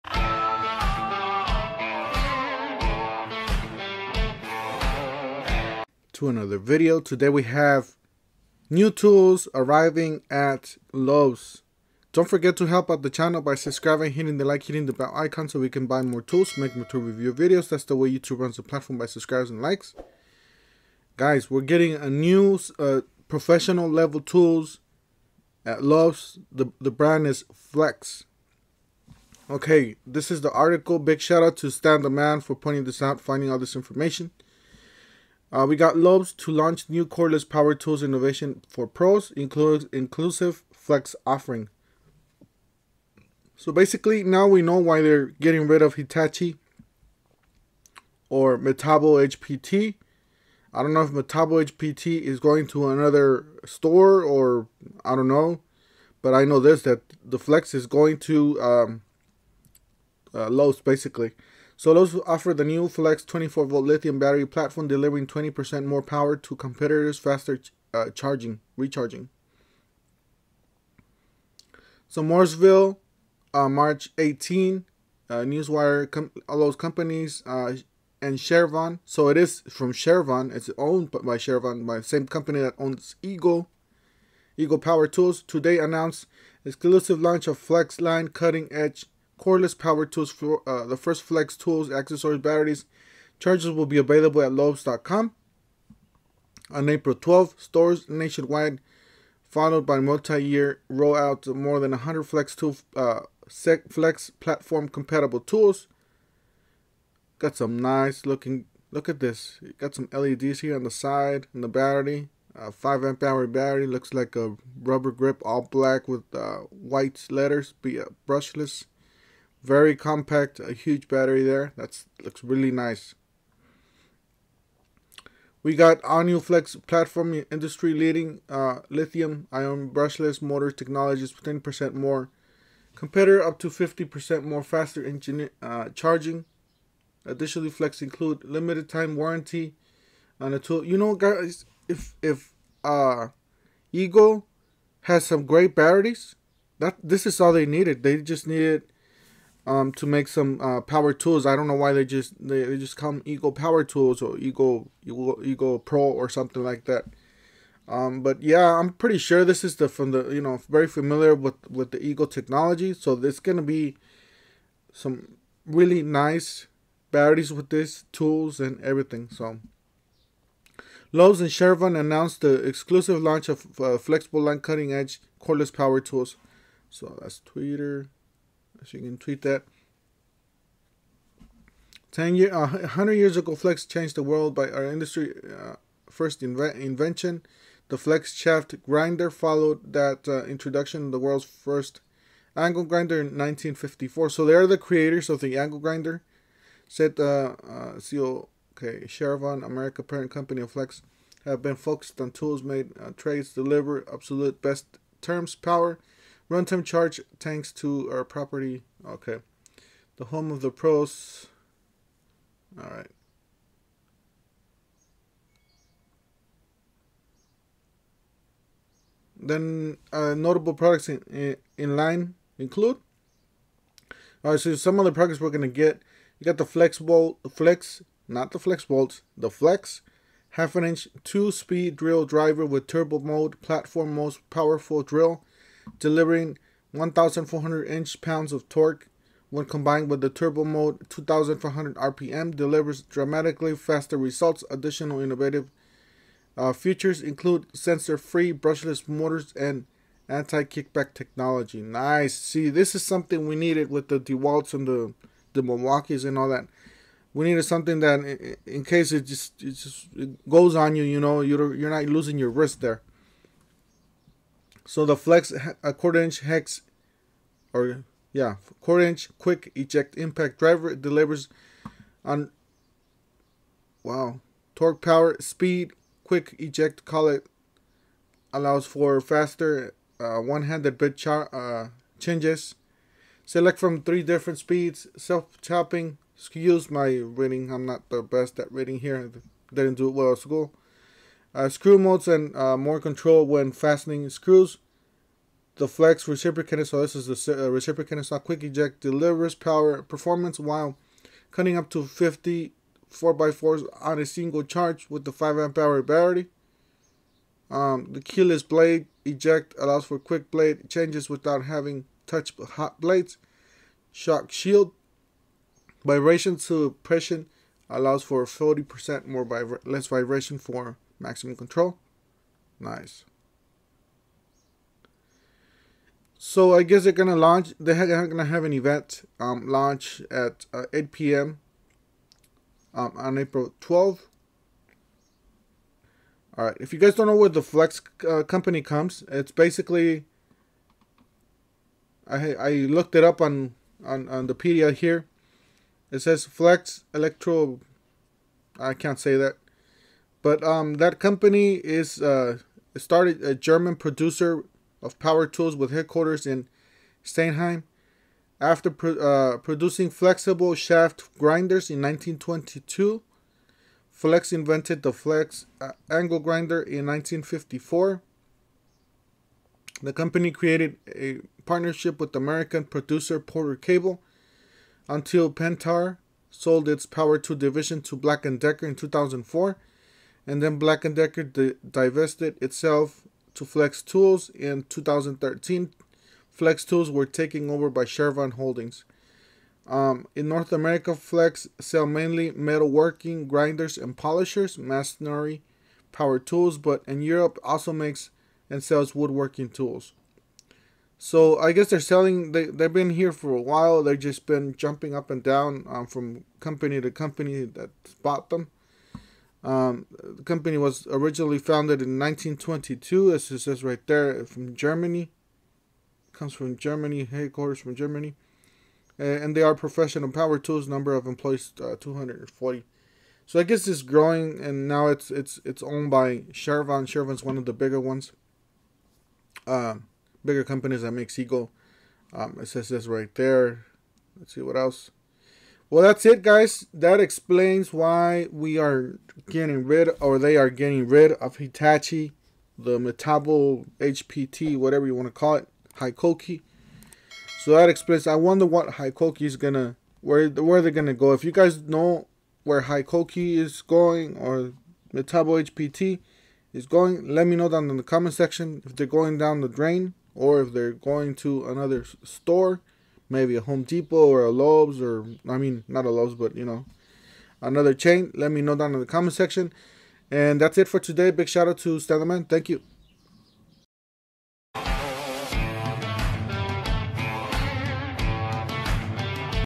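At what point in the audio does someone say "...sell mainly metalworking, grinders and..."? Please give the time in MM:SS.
06:31.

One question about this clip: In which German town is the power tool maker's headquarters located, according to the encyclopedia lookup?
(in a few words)
Steinheim.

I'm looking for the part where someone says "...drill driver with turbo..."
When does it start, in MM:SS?
03:51.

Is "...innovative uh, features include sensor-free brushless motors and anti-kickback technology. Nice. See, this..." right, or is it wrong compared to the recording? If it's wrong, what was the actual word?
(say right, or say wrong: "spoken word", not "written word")
right.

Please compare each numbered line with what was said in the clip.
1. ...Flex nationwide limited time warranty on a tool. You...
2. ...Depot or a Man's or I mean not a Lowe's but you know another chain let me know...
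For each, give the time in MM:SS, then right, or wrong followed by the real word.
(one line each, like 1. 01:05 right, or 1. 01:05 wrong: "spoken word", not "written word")
1. 02:17 wrong: "include", not "nationwide"
2. 07:43 wrong: "Lowe", not "Man".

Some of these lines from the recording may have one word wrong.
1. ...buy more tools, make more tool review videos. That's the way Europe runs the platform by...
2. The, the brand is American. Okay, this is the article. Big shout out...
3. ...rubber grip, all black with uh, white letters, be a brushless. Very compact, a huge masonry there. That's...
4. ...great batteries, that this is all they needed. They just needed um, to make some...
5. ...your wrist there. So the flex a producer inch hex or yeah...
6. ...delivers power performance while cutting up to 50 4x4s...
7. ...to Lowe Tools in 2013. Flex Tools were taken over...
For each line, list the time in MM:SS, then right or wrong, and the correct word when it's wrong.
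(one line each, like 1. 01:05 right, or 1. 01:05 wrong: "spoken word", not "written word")
1. 00:15 wrong: "YouTube", not "Europe"
2. 00:26 wrong: "Flex", not "American"
3. 01:54 wrong: "battery", not "masonry"
4. 02:25 right
5. 04:22 wrong: "quarter", not "producer"
6. 04:59 right
7. 06:23 wrong: "Flex", not "Lowe".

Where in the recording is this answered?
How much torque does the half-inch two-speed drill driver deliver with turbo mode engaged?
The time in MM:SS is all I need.
03:56.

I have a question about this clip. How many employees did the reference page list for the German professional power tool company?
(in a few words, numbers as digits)
240.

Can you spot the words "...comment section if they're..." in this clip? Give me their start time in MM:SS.
07:38.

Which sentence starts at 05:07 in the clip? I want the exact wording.
Um, the keyless blade eject allows for quick blade changes without having touch hot blades.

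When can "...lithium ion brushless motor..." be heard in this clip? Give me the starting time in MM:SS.
02:08.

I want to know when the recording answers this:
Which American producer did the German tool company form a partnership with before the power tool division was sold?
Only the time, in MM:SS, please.
06:13.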